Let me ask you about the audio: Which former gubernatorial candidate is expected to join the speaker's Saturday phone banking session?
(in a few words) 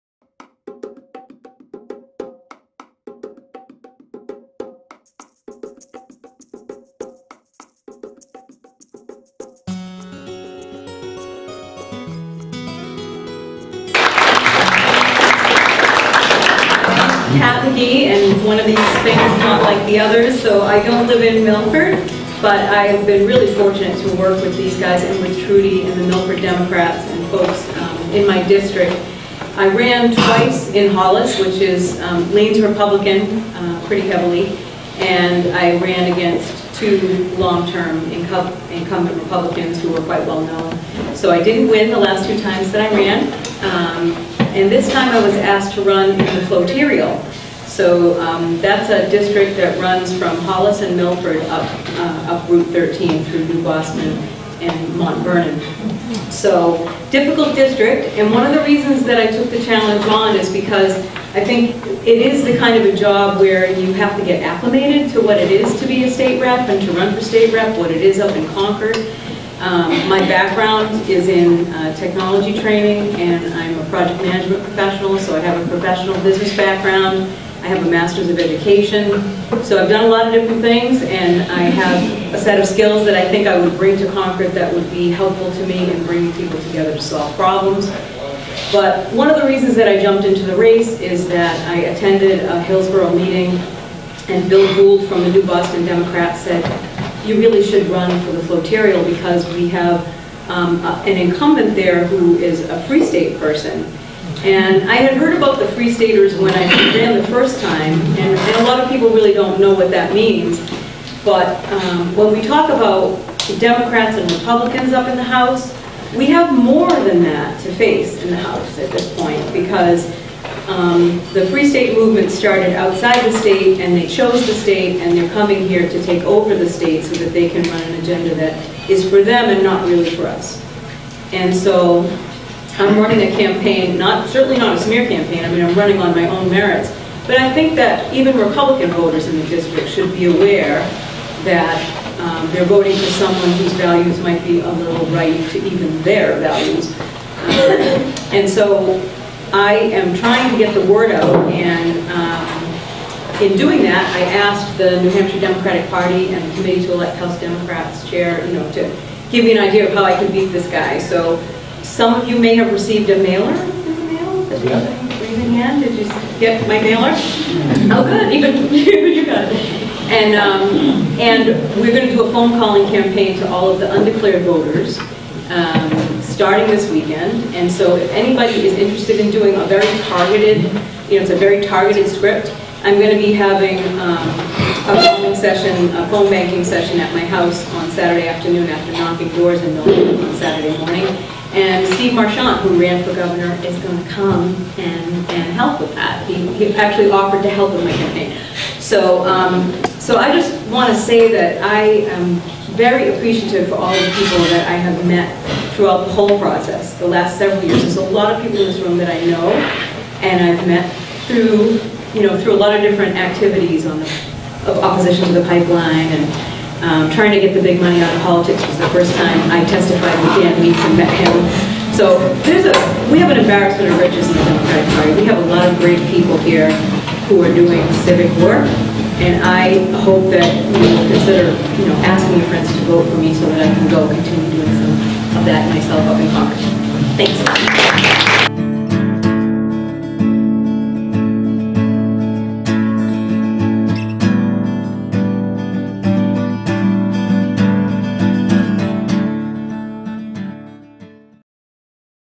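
Steve Marchand.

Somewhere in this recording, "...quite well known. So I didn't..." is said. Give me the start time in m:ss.
0:40.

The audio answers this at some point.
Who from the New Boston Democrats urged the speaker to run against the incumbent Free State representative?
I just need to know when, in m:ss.
1:34.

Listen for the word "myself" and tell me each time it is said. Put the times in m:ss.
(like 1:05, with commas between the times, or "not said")
3:55.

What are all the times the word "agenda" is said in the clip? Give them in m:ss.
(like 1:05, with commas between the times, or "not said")
2:07.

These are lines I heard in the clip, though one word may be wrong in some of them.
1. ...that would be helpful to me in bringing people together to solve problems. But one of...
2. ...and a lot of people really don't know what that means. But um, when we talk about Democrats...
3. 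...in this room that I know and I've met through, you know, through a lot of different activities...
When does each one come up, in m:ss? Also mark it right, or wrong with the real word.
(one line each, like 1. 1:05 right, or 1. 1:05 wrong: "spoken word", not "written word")
1. 1:24 right
2. 1:48 right
3. 3:28 right.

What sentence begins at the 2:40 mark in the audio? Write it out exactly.
So some of you may have received a mailer in the mail.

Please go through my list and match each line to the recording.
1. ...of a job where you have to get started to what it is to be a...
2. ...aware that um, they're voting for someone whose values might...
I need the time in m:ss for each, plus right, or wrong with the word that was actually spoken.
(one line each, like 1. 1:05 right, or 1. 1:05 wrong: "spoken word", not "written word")
1. 1:02 wrong: "acclimated", not "started"
2. 2:20 right.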